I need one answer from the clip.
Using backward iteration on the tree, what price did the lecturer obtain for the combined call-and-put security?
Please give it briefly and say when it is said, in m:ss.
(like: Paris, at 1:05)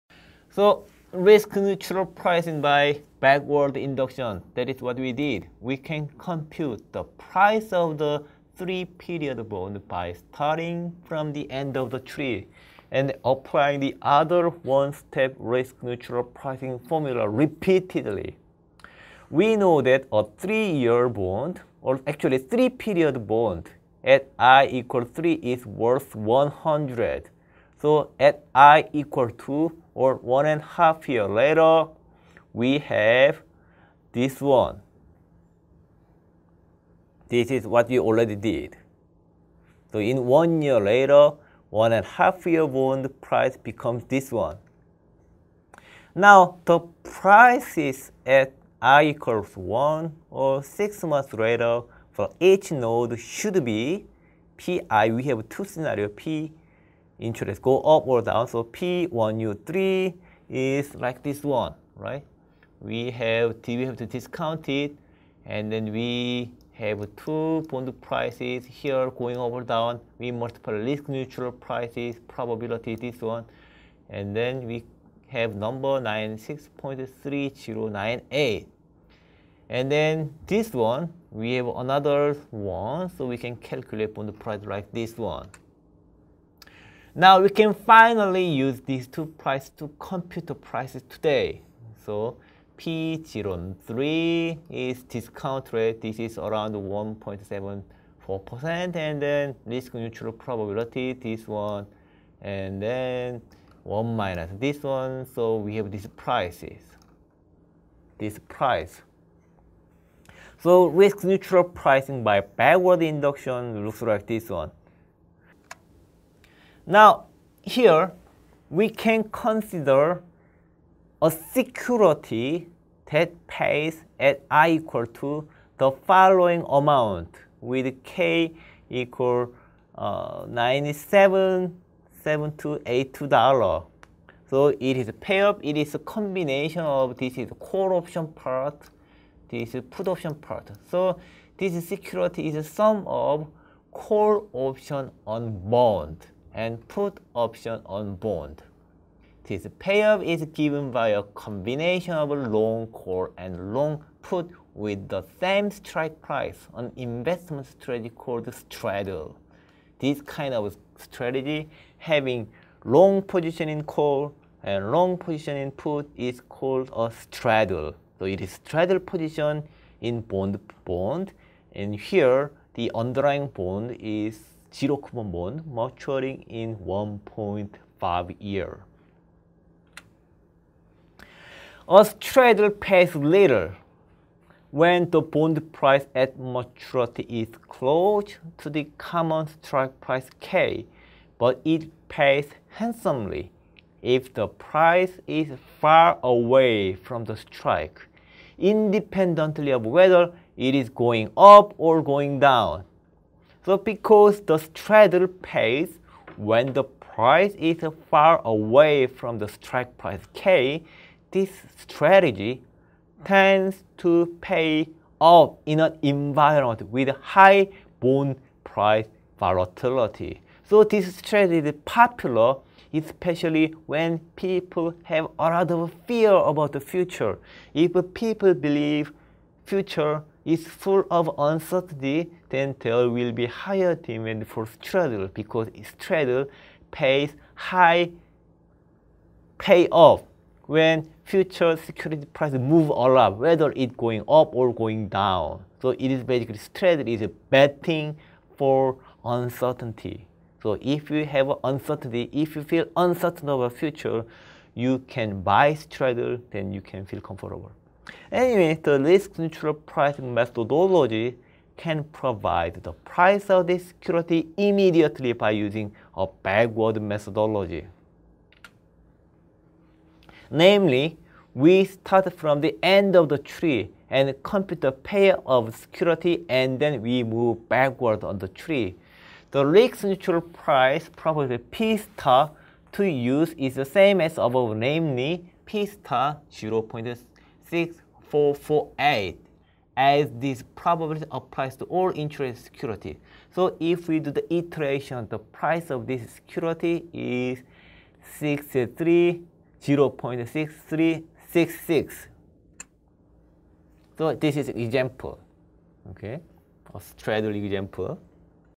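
0.6366, at 4:59.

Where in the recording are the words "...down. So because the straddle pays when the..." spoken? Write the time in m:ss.
3:22.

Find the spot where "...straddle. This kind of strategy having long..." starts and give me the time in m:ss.
2:38.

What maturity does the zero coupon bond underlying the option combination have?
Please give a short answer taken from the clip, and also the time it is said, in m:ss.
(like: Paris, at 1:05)
1.5 years, at 2:56.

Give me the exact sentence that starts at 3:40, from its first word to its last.
So this strategy is popular especially when people have a lot of fear about the future.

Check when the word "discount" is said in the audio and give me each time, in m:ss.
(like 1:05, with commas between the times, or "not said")
1:04, 1:35.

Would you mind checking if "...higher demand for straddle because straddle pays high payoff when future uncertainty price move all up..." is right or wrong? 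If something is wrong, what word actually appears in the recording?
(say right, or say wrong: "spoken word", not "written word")
wrong: "security", not "uncertainty".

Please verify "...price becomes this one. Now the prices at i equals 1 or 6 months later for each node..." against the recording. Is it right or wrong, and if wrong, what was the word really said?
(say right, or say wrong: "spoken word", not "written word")
right.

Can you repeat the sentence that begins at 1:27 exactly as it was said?
Now we can finally use these two prices to compute the prices today.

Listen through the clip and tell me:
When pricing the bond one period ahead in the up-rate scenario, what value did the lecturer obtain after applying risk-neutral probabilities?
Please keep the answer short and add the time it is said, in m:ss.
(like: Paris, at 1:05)
96.3098, at 1:16.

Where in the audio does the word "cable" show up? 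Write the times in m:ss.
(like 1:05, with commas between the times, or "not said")
not said.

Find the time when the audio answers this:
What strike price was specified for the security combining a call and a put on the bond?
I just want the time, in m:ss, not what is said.
2:10.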